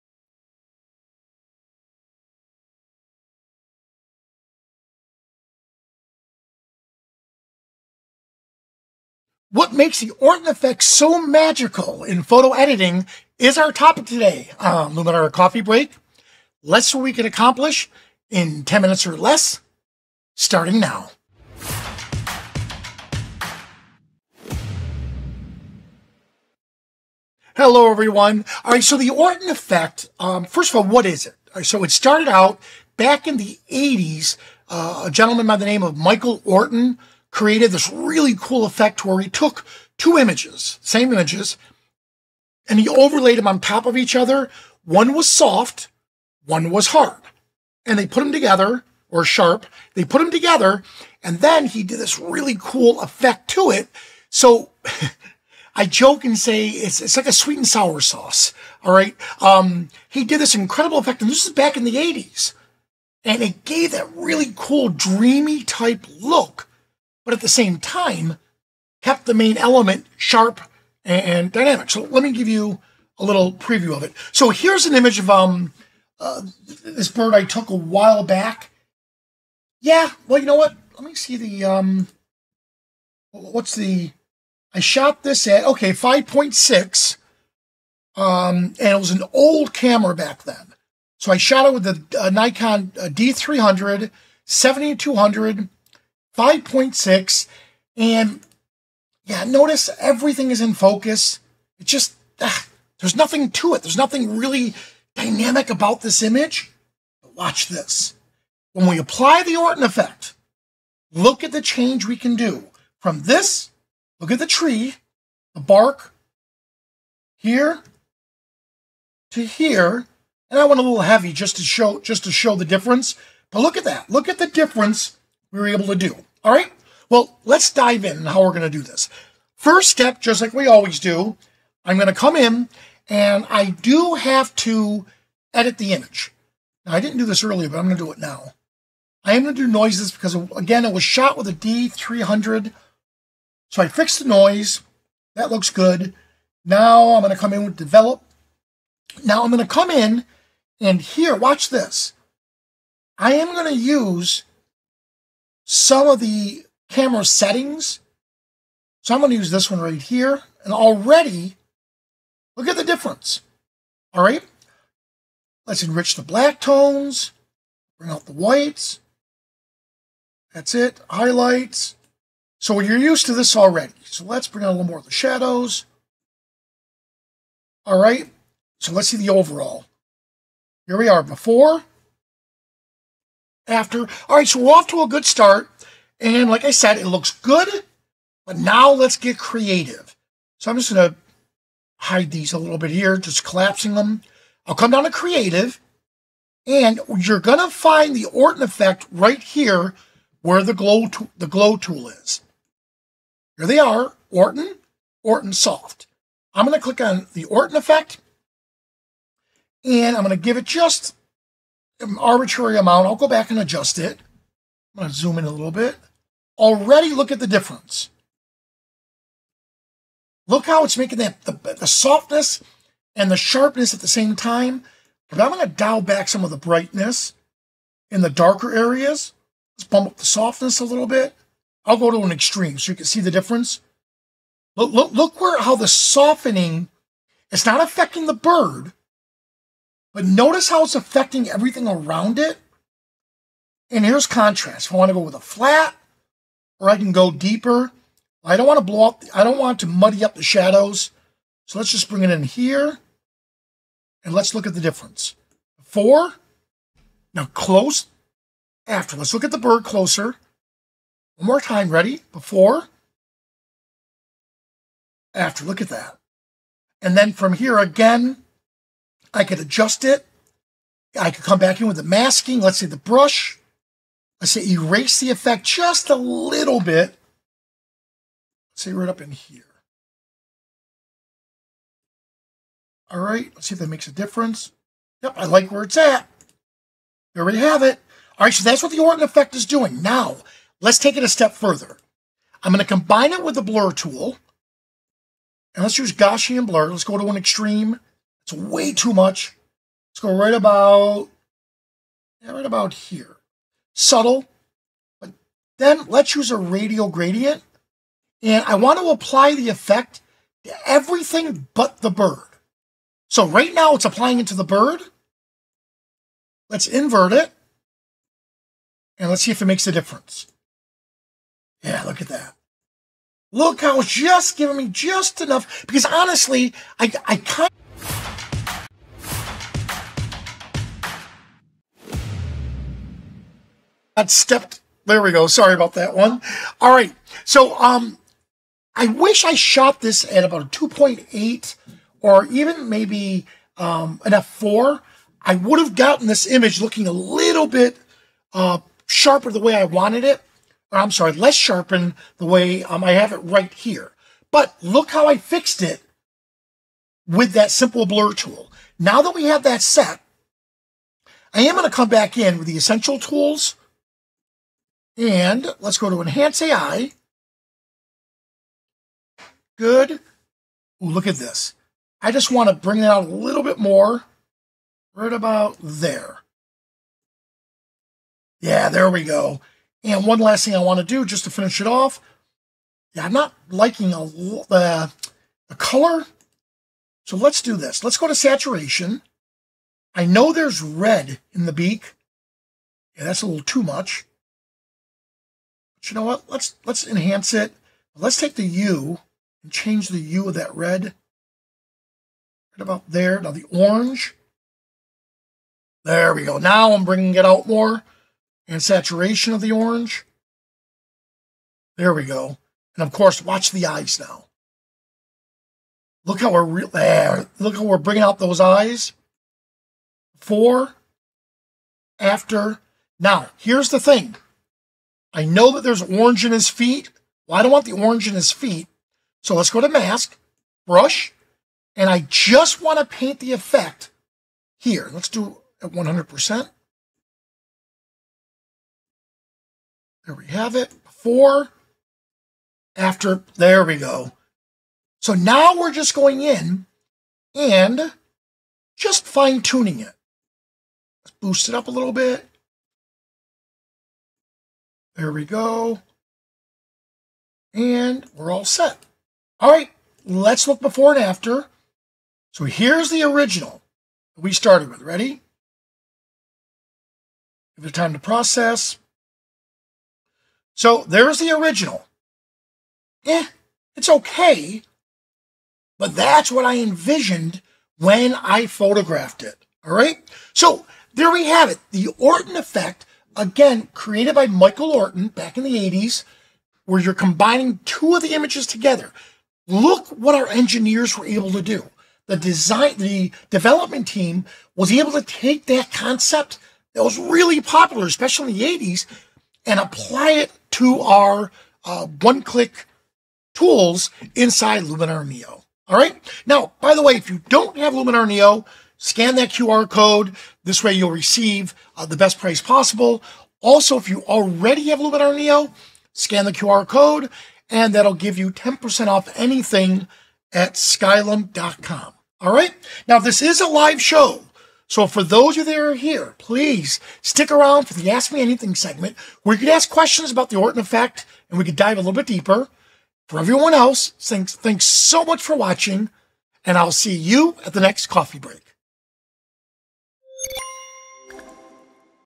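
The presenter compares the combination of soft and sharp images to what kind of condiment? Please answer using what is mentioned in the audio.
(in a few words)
sweet and sour sauce.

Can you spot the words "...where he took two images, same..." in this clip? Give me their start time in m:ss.
0:39.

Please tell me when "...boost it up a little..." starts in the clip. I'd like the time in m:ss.
7:31.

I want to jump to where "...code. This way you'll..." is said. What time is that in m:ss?
8:29.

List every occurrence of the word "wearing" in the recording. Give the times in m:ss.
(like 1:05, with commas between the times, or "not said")
not said.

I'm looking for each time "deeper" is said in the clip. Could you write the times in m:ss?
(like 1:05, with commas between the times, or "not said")
4:07, 8:52.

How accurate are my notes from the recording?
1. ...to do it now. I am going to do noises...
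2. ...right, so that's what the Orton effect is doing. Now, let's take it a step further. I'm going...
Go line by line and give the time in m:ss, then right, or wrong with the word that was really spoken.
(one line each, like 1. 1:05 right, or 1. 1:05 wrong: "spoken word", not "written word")
1. 2:17 right
2. 4:48 right.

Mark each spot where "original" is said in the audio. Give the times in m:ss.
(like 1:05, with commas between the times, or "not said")
7:43, 7:51.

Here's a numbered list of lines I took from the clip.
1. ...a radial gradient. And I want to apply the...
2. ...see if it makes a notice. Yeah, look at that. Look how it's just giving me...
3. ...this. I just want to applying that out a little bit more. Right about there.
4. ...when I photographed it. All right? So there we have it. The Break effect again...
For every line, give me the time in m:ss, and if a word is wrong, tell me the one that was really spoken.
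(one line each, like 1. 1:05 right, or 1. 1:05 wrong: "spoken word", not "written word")
1. 5:06 right
2. 5:19 wrong: "difference", not "notice"
3. 6:11 wrong: "bring", not "applying"
4. 7:57 wrong: "Orton", not "Break".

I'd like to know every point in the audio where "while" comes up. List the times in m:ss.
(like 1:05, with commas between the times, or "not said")
1:17.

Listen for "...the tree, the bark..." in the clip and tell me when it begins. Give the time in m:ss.
1:54.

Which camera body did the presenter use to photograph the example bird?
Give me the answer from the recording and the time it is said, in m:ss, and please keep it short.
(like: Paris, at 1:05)
Nikon D300, at 1:32.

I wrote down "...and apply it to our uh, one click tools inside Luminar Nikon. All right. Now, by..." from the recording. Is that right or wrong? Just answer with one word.
wrong.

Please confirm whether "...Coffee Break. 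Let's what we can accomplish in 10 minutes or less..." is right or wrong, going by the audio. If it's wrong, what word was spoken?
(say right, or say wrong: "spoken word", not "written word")
right.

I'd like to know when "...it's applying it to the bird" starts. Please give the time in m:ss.
5:13.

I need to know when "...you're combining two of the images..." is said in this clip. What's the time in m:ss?
8:07.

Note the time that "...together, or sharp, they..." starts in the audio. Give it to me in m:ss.
0:48.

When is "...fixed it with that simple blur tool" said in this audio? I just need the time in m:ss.
5:55.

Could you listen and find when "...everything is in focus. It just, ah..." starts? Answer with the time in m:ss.
1:39.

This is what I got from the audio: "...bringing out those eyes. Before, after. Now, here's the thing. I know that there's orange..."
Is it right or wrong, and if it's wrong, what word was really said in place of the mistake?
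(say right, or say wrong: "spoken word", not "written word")
right.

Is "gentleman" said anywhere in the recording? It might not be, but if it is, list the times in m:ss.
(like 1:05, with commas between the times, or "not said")
0:35.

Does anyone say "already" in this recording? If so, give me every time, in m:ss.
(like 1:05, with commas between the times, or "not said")
2:40, 2:53, 3:36, 8:34.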